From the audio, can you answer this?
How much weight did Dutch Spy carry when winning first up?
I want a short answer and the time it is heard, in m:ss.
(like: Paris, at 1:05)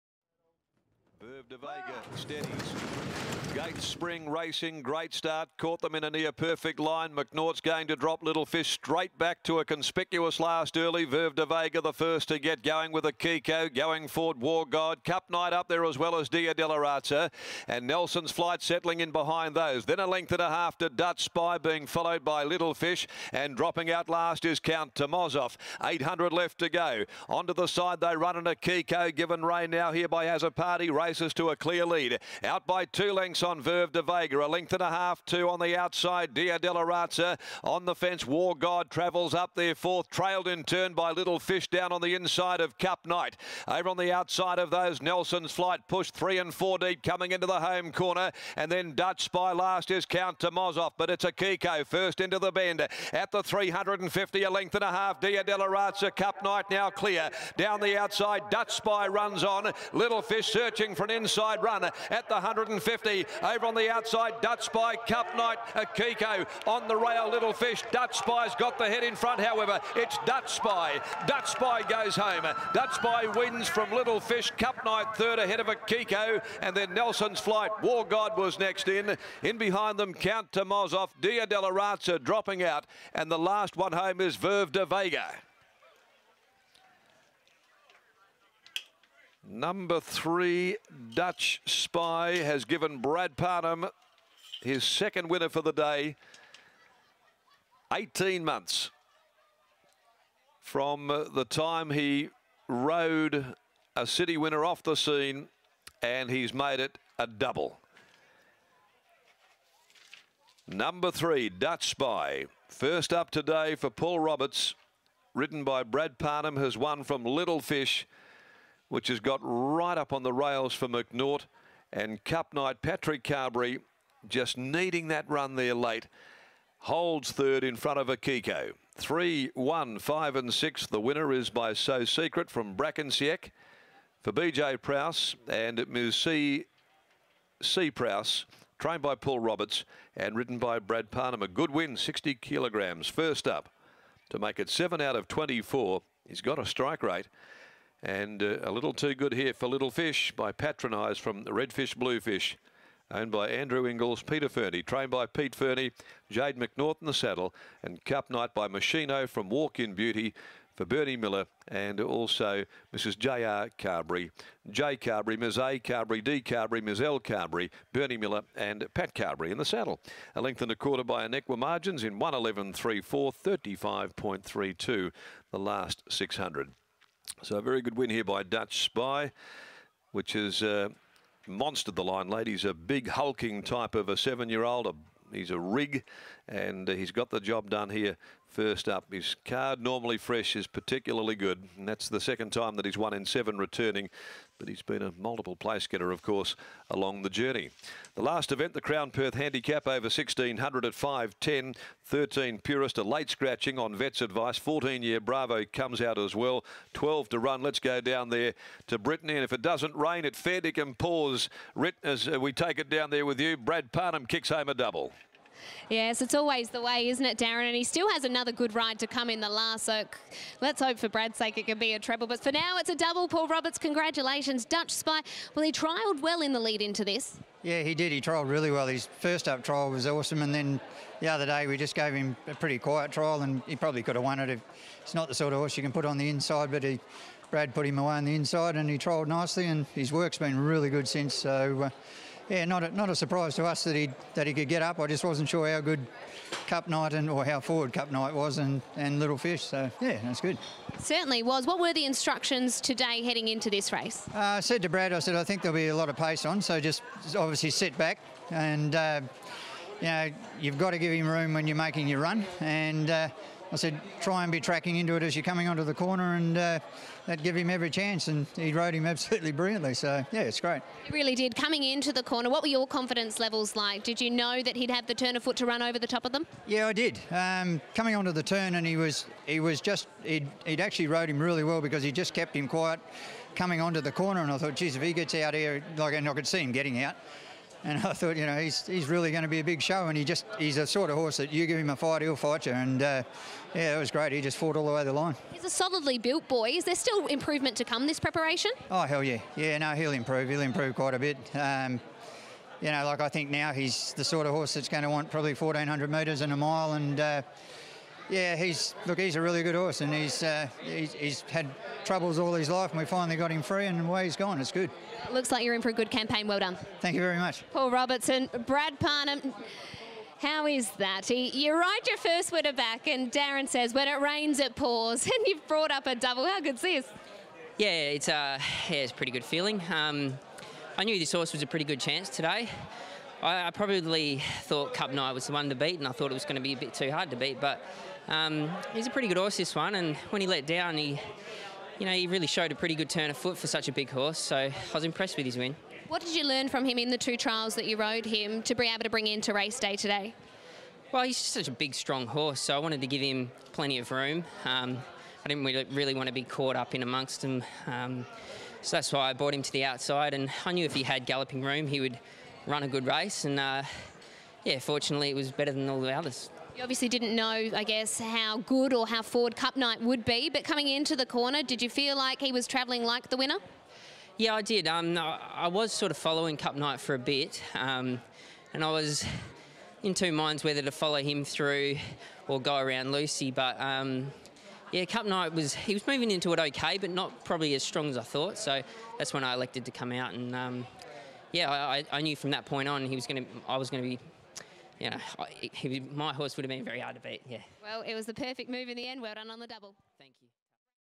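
60 kilograms, at 2:21.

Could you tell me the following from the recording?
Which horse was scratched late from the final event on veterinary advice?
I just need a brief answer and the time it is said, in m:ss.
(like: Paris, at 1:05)
Purist, at 3:22.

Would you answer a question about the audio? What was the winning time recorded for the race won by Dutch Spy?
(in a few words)
111.34.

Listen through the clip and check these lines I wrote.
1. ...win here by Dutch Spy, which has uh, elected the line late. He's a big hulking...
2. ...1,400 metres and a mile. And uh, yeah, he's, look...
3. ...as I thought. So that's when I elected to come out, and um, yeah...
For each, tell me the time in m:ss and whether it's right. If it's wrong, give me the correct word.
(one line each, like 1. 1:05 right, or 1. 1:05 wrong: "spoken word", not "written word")
1. 2:57 wrong: "monstered", not "elected"
2. 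5:05 right
3. 6:28 right.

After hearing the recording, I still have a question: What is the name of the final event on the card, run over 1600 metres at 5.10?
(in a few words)
Crown Perth Handicap.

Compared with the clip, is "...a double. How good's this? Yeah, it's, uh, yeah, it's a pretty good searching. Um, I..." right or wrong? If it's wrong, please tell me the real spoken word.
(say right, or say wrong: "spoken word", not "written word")
wrong: "feeling", not "searching".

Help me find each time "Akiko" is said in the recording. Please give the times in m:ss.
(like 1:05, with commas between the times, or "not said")
0:13, 0:28, 0:51, 1:05, 1:15, 2:08.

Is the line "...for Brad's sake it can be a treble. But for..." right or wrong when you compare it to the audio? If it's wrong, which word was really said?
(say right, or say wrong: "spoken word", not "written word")
right.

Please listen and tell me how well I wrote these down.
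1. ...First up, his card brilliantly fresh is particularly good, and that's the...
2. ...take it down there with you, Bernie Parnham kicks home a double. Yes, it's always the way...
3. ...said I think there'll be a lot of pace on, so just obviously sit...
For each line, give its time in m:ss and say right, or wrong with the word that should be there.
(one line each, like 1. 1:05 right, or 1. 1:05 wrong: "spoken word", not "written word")
1. 3:08 wrong: "normally", not "brilliantly"
2. 3:32 wrong: "Brad", not "Bernie"
3. 4:15 right.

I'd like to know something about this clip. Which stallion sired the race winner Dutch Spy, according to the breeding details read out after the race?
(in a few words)
So Secret.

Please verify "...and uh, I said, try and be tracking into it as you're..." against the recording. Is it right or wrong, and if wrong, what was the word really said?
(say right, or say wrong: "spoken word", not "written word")
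right.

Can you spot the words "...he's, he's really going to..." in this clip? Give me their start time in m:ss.
4:48.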